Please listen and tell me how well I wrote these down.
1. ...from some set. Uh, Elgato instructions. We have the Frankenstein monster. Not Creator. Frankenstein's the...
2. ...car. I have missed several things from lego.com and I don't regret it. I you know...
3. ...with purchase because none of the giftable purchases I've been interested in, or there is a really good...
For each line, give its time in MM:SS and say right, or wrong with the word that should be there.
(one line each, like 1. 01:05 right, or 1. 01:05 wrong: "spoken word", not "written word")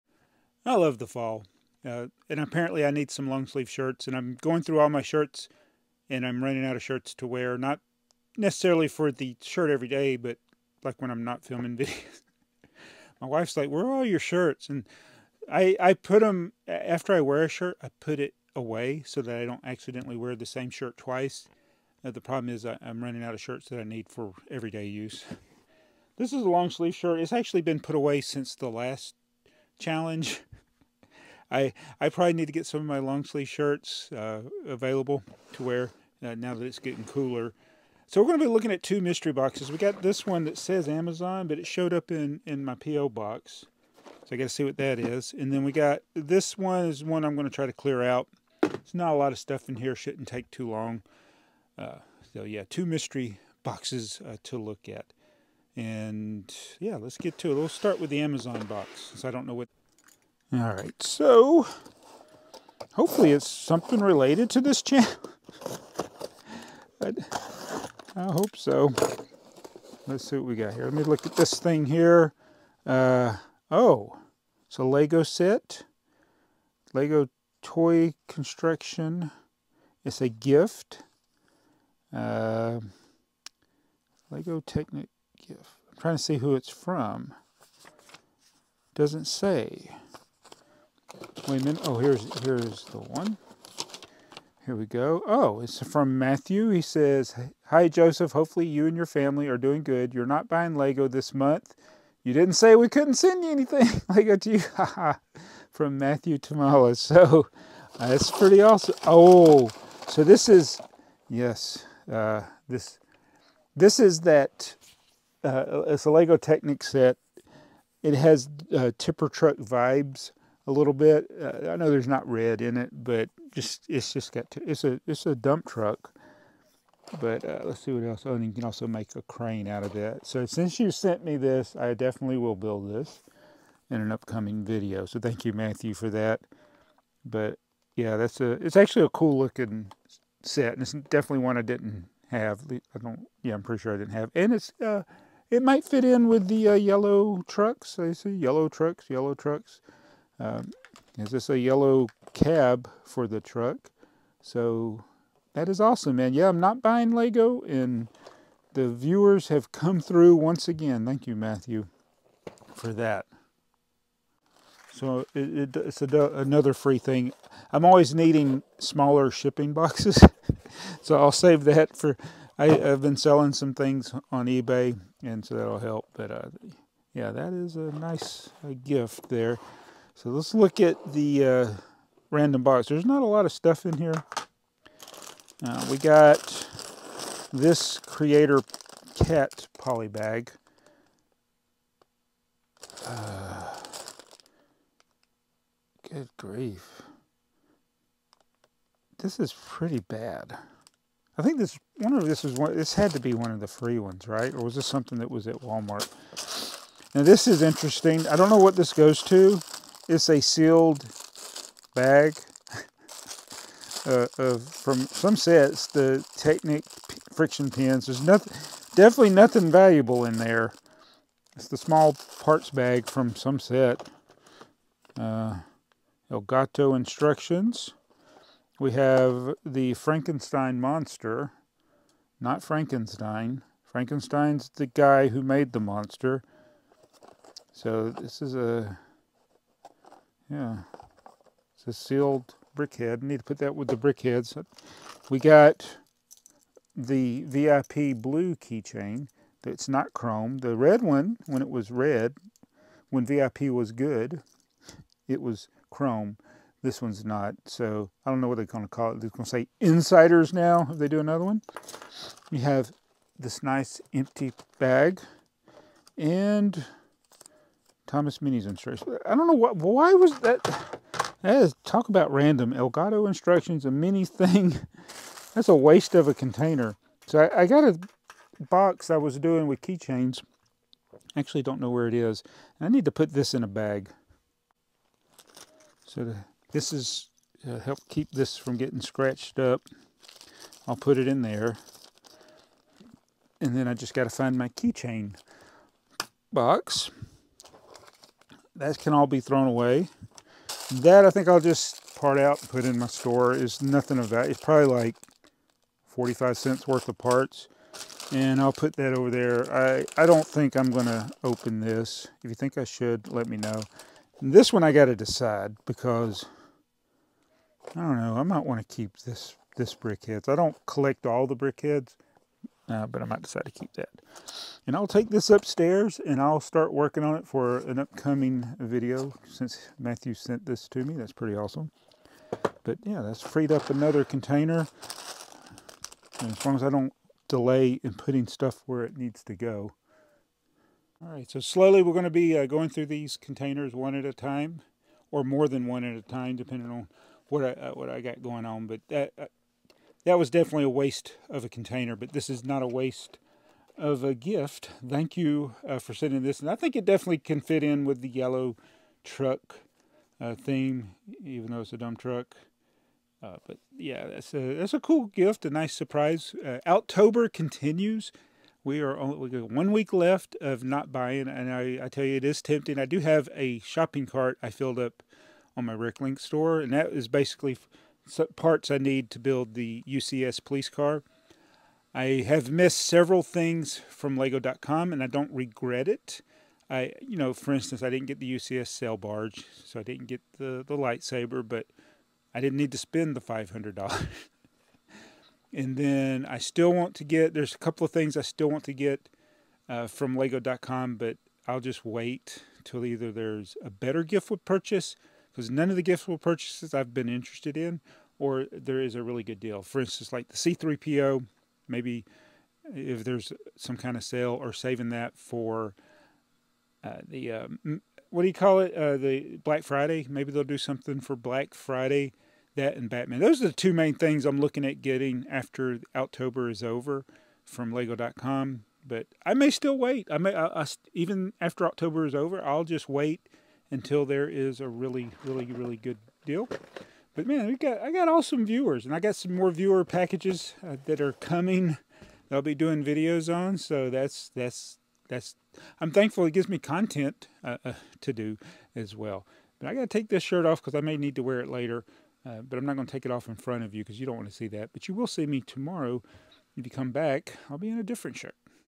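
1. 03:43 wrong: "Frankenstein", not "Creator"
2. 06:20 right
3. 06:44 right.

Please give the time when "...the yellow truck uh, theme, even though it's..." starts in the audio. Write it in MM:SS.
05:58.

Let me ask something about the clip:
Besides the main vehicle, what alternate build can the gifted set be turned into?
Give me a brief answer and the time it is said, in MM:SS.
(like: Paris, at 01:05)
A crane, at 02:09.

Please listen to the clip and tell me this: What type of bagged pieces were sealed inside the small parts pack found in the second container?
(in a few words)
Technic friction pins.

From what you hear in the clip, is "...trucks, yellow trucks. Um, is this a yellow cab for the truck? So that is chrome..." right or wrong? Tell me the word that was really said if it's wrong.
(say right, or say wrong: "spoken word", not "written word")
wrong: "awesome", not "chrome".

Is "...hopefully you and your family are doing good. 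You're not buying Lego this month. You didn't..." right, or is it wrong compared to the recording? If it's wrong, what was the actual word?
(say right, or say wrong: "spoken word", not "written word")
right.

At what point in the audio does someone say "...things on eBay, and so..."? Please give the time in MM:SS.
02:53.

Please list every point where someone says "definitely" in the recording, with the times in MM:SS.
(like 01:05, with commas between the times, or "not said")
02:11, 02:20, 03:38, 05:50, 05:57.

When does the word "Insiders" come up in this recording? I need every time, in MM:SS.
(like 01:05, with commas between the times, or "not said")
04:19.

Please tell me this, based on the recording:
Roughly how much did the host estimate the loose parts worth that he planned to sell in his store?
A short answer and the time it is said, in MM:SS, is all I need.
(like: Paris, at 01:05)
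45 cents, at 05:06.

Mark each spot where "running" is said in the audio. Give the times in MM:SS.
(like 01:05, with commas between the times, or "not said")
00:06, 00:23.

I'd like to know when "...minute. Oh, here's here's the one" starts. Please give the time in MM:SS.
01:31.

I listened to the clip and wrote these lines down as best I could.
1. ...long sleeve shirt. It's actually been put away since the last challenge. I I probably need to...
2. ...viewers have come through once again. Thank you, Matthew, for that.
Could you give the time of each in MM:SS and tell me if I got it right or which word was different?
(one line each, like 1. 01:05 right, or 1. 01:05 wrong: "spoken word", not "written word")
1. 00:26 right
2. 02:38 right.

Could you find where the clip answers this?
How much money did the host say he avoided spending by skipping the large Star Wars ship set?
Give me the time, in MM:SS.
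06:33.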